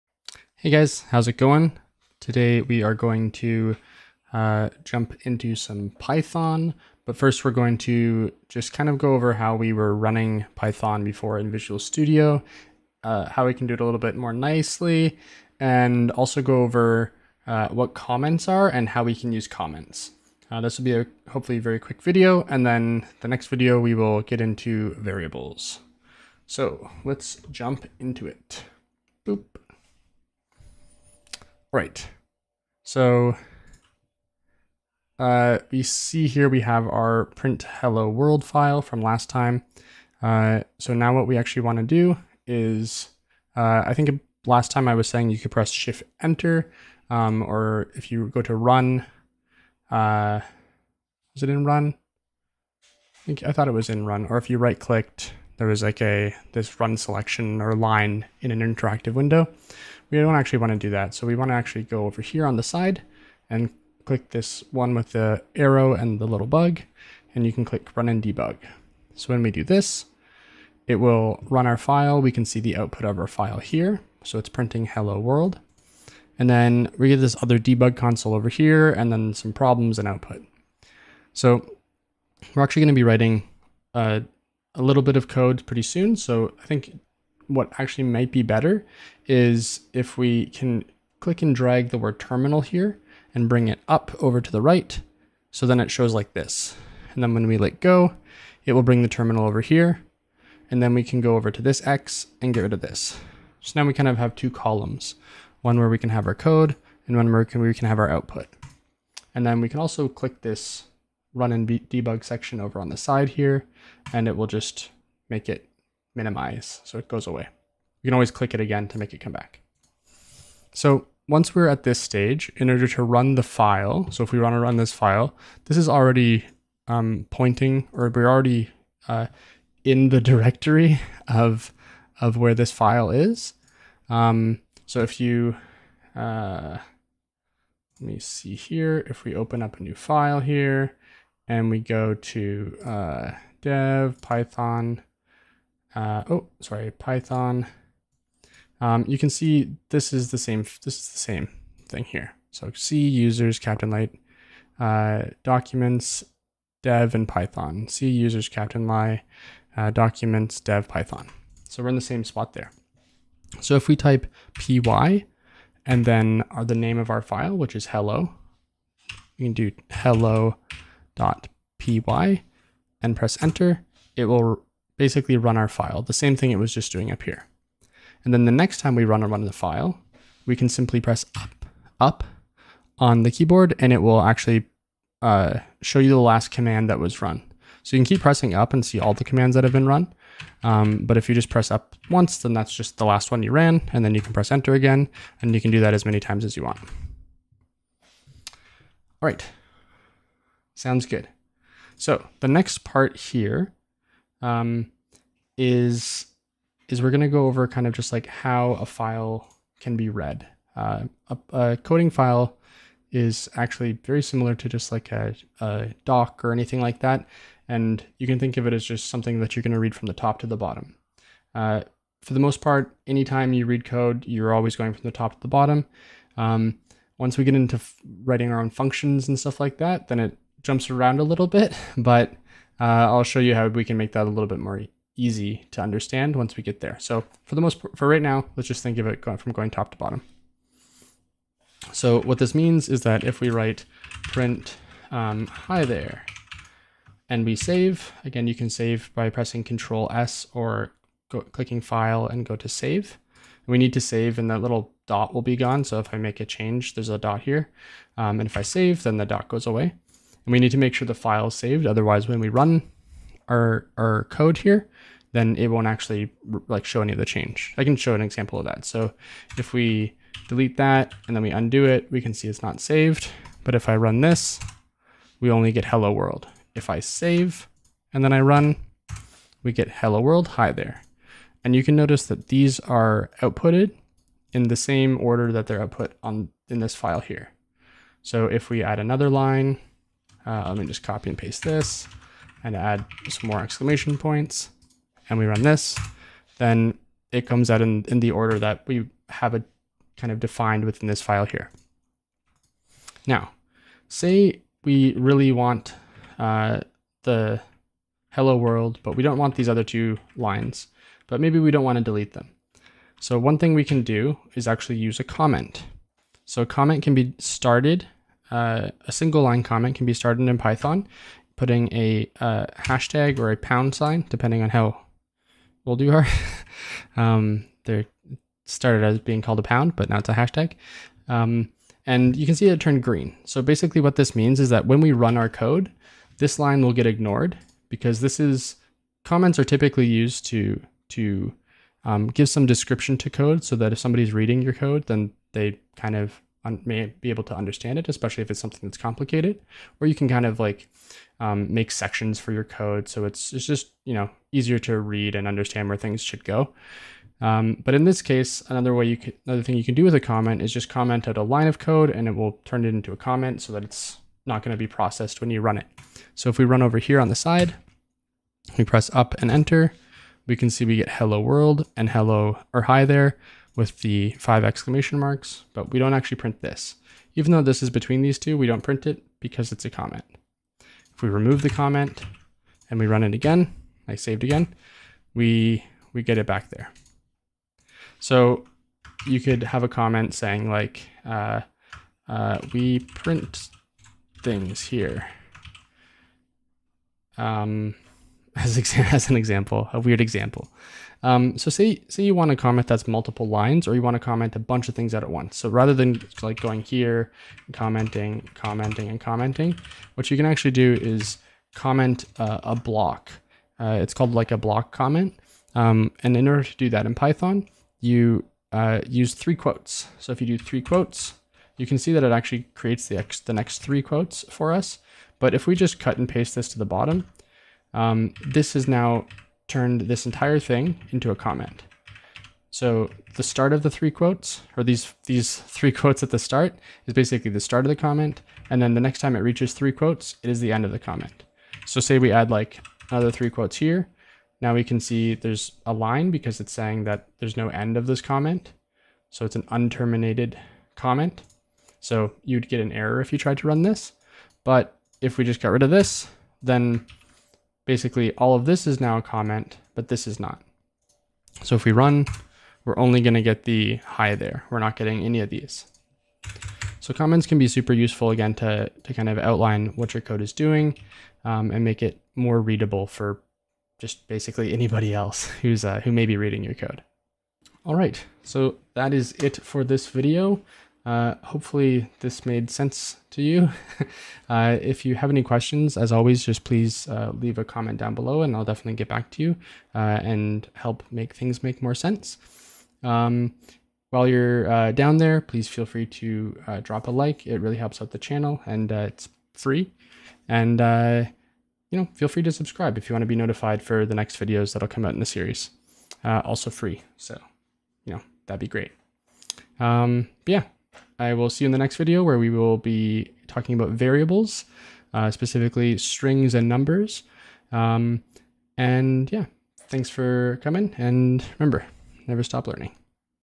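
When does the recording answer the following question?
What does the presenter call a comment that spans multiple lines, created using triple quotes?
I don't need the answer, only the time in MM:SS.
06:54.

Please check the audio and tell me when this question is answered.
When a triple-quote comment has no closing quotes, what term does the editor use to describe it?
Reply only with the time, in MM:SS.
07:29.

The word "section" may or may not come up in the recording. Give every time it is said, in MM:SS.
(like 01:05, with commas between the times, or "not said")
01:52, 05:51.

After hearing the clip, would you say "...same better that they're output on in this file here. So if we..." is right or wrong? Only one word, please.
wrong.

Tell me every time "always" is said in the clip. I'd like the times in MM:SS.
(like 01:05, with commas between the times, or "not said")
01:58, 03:44, 08:06.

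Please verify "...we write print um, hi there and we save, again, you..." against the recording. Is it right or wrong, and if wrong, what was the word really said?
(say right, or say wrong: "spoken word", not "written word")
right.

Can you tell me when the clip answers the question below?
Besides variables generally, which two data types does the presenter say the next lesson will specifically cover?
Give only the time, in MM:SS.
08:35.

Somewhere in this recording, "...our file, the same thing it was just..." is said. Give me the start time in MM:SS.
02:55.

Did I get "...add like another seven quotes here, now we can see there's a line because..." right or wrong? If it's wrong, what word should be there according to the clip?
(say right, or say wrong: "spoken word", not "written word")
wrong: "three", not "seven".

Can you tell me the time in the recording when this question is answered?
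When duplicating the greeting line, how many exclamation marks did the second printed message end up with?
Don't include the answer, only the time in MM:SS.
06:14.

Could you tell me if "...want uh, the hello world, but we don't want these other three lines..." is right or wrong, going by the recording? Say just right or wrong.
wrong.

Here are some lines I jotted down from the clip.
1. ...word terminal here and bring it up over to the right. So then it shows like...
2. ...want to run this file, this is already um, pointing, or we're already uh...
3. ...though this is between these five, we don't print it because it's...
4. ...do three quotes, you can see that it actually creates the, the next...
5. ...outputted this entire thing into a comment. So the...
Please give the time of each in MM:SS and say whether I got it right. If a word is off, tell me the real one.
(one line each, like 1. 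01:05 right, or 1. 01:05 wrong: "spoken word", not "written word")
1. 01:31 right
2. 02:04 right
3. 06:17 wrong: "two", not "five"
4. 07:00 right
5. 07:09 wrong: "turned", not "outputted".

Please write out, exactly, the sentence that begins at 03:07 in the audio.
So you can keep pressing up and see all the commands that have been run.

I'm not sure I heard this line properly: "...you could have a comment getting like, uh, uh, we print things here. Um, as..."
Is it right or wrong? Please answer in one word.
wrong.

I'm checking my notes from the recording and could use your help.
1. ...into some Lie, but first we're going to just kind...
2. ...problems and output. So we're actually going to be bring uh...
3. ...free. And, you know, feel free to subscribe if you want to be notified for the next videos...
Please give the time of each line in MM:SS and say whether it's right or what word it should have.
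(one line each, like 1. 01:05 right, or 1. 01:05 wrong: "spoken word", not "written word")
1. 00:05 wrong: "Python", not "Lie"
2. 01:19 wrong: "writing", not "bring"
3. 08:19 right.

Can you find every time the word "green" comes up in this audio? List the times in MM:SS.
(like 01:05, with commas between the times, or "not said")
05:33.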